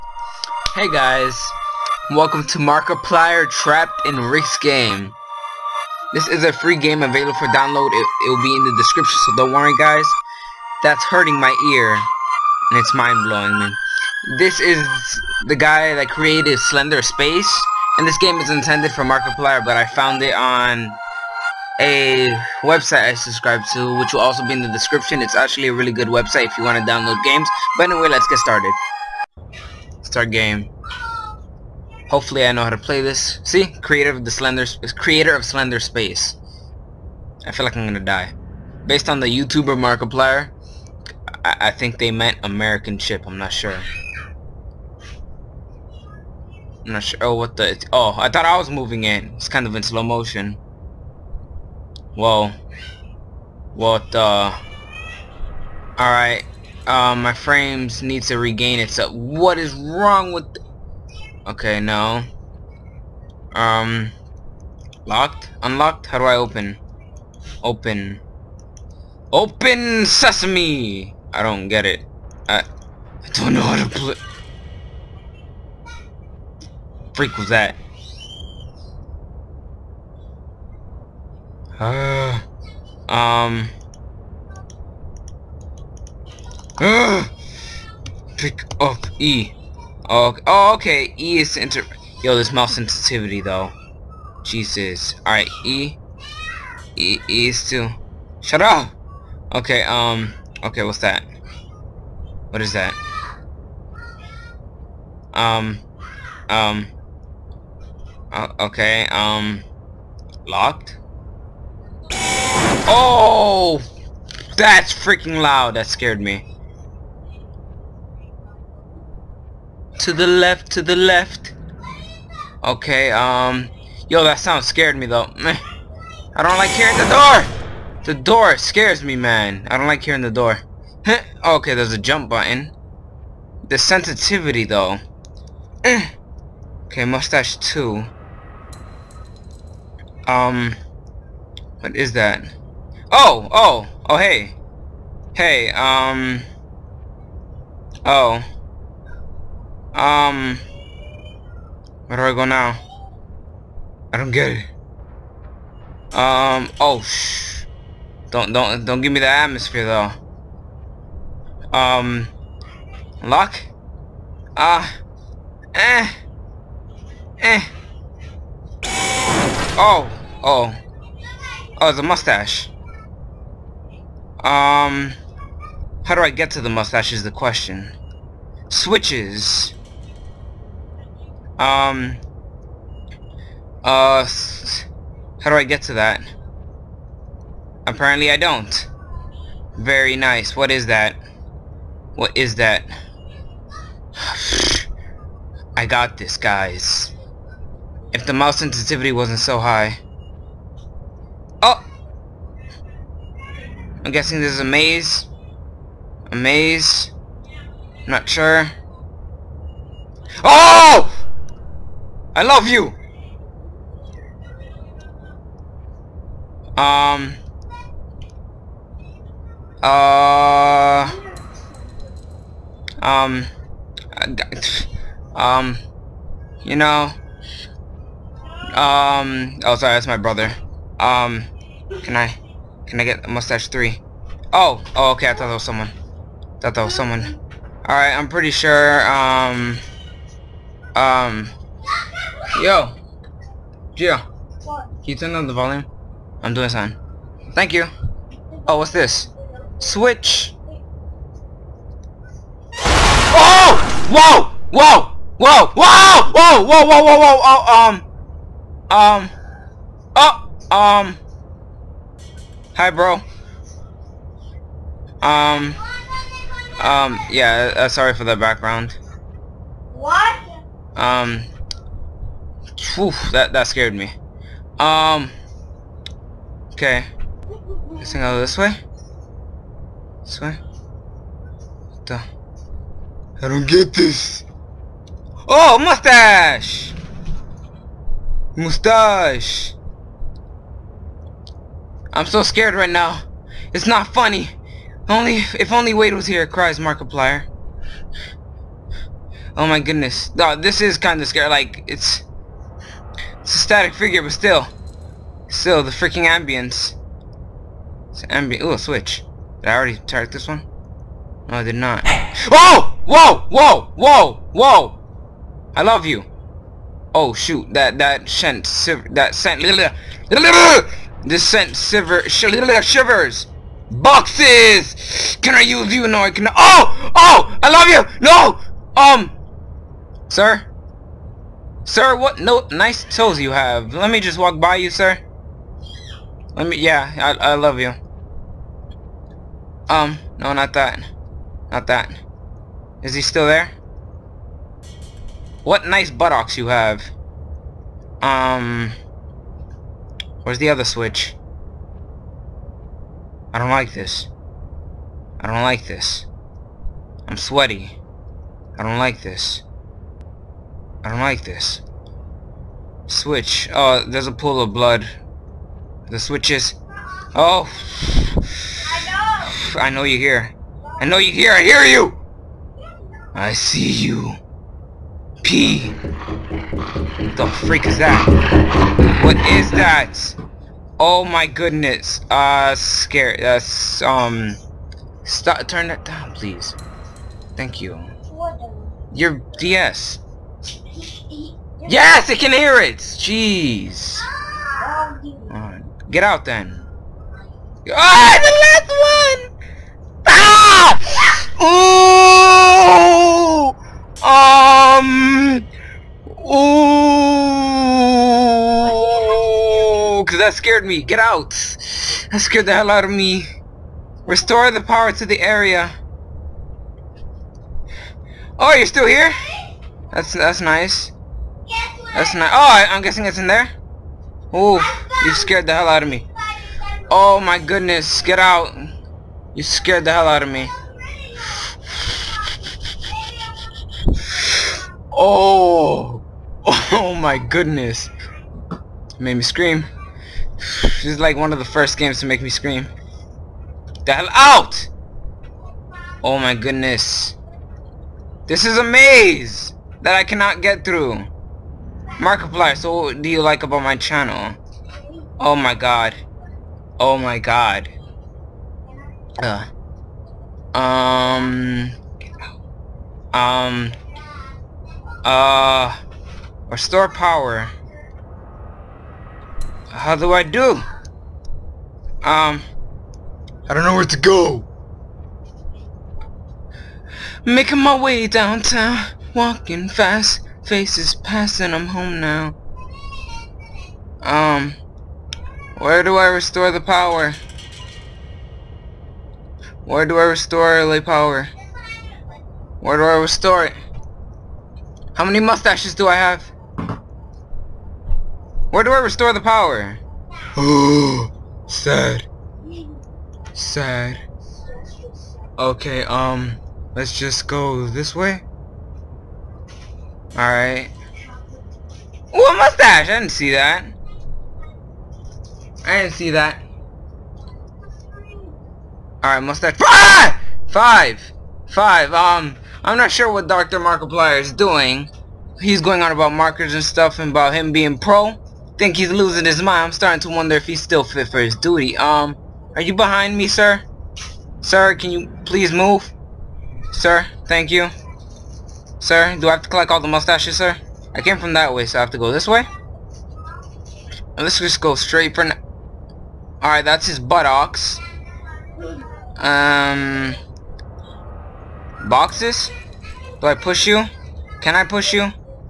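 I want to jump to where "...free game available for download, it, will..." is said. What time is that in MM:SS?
00:06.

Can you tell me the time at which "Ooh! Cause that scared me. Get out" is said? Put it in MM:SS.
06:46.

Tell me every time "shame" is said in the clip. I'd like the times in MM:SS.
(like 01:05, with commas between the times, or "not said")
not said.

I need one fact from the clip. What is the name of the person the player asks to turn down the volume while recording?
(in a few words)
Gio.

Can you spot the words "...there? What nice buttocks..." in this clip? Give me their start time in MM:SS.
05:43.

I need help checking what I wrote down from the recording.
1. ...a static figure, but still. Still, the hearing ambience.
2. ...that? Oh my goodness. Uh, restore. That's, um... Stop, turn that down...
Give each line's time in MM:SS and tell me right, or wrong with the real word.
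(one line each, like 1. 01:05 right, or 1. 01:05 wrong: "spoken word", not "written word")
1. 05:03 wrong: "freaking", not "hearing"
2. 06:19 wrong: "scare", not "restore".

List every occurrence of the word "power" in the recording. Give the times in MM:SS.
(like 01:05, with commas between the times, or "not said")
06:54, 07:47, 08:06, 08:11, 08:19.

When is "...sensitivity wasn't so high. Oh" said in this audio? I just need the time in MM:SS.
03:18.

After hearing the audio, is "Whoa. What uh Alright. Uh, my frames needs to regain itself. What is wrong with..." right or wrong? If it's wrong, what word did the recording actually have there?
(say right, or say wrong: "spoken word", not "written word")
right.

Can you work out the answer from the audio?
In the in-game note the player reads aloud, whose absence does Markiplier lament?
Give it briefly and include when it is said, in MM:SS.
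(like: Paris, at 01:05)
Wade, at 04:55.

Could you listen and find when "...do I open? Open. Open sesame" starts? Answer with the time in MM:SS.
01:06.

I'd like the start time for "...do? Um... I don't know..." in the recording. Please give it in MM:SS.
07:50.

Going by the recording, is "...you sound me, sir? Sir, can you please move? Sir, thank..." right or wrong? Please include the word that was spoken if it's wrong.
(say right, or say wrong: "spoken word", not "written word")
wrong: "behind", not "sound".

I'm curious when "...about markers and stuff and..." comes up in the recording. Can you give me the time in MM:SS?
08:46.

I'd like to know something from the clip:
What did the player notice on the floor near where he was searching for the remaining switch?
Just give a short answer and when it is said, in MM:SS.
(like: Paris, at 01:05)
a pool of blood, at 06:04.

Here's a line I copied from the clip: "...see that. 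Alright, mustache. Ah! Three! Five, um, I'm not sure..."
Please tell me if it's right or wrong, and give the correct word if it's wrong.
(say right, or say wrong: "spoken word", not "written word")
wrong: "Five", not "Three".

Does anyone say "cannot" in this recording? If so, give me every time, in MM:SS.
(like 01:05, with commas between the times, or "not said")
07:30.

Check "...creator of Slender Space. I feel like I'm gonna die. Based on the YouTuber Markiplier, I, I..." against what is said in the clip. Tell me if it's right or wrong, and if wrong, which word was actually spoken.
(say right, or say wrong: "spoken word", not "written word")
right.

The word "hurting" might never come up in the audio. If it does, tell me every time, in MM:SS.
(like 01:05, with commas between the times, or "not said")
00:11.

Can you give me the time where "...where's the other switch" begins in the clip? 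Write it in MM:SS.
05:50.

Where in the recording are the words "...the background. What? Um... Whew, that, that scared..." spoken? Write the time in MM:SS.
04:28.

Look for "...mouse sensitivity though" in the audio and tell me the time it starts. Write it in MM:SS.
01:32.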